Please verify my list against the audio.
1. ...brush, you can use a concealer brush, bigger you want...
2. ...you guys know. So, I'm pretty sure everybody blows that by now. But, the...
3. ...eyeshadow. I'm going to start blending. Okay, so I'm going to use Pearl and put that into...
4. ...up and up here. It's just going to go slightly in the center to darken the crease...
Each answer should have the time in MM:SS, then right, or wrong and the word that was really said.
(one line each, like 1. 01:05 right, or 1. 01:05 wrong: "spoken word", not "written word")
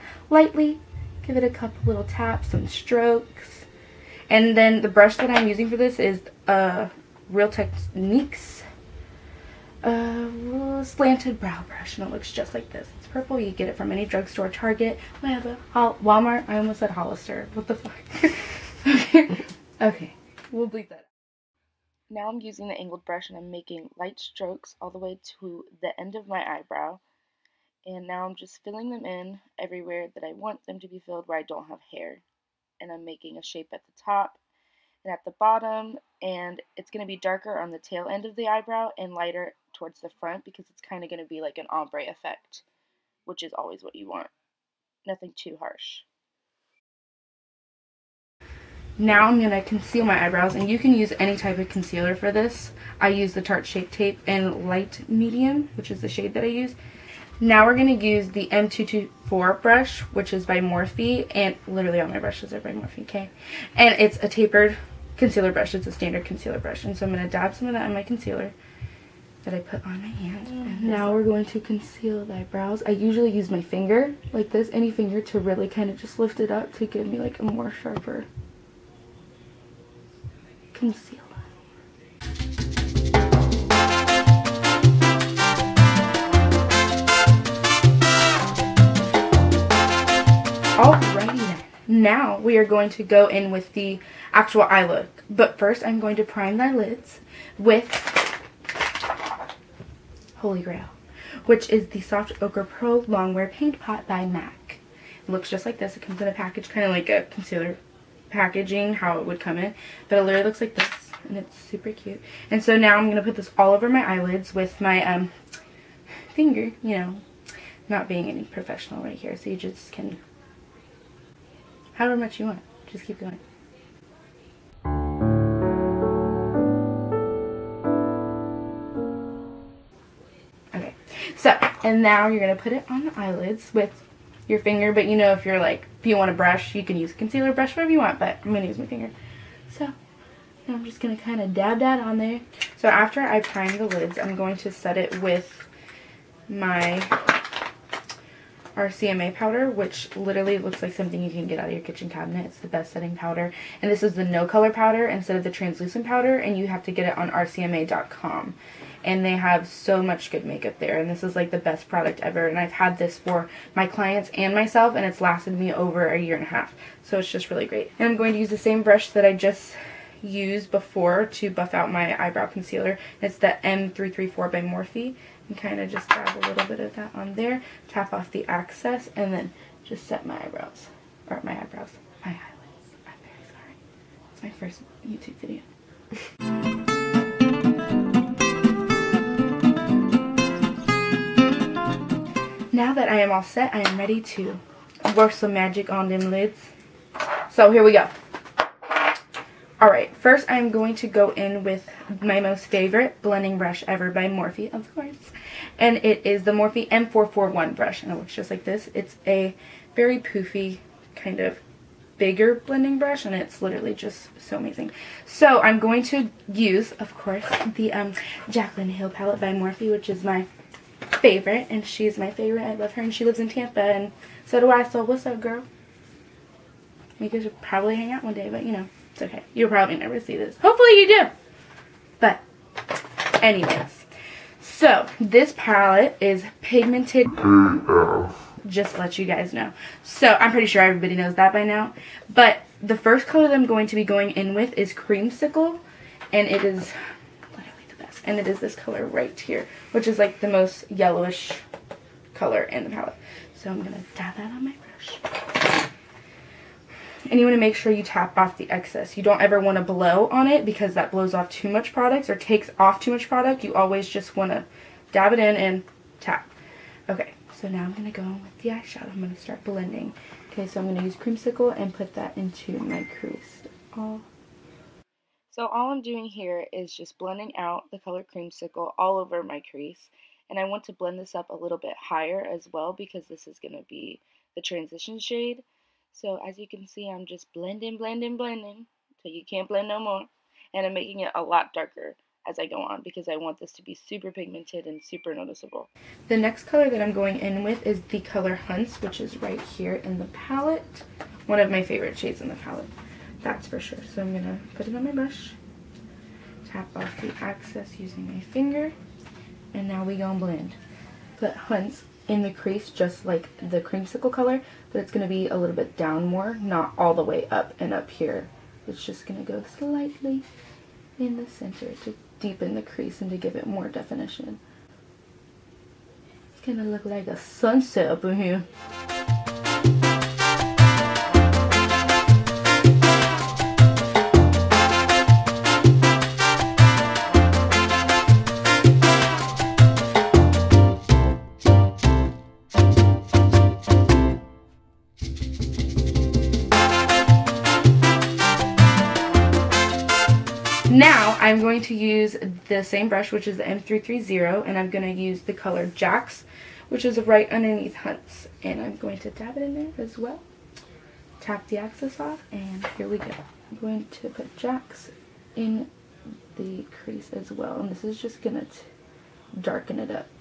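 1. 02:16 wrong: "whatever", not "bigger"
2. 03:59 wrong: "knows", not "blows"
3. 04:28 wrong: "Creamsicle", not "Pearl"
4. 05:17 wrong: "deepen", not "darken".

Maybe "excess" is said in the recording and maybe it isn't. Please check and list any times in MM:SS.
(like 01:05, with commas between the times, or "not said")
02:58, 04:18, 05:07.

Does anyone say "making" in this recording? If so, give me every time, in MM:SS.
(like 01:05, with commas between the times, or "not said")
00:23, 00:33, 04:50.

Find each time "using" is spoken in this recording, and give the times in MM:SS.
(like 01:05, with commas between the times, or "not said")
00:05, 00:22, 05:07.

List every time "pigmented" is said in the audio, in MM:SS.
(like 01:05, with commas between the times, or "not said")
03:56, 04:54.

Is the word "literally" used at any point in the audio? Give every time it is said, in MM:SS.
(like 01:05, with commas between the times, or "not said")
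01:01, 01:50, 02:30, 03:33, 04:07.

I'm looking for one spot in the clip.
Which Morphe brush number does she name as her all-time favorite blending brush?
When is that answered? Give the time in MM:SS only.
03:26.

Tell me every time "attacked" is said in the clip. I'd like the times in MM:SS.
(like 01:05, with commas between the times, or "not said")
not said.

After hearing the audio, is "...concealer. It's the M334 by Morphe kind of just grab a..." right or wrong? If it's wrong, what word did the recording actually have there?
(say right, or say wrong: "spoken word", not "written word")
right.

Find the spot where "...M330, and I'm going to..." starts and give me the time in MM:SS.
05:53.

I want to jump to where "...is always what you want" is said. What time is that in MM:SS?
00:43.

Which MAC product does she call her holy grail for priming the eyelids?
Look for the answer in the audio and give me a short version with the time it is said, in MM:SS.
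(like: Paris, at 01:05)
Soft Ochre, at 01:42.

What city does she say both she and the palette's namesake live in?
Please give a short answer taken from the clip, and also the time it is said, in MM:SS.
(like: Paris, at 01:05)
Tampa, at 03:43.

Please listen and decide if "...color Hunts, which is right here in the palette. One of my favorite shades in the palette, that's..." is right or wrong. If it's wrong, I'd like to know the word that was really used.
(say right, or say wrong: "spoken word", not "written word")
right.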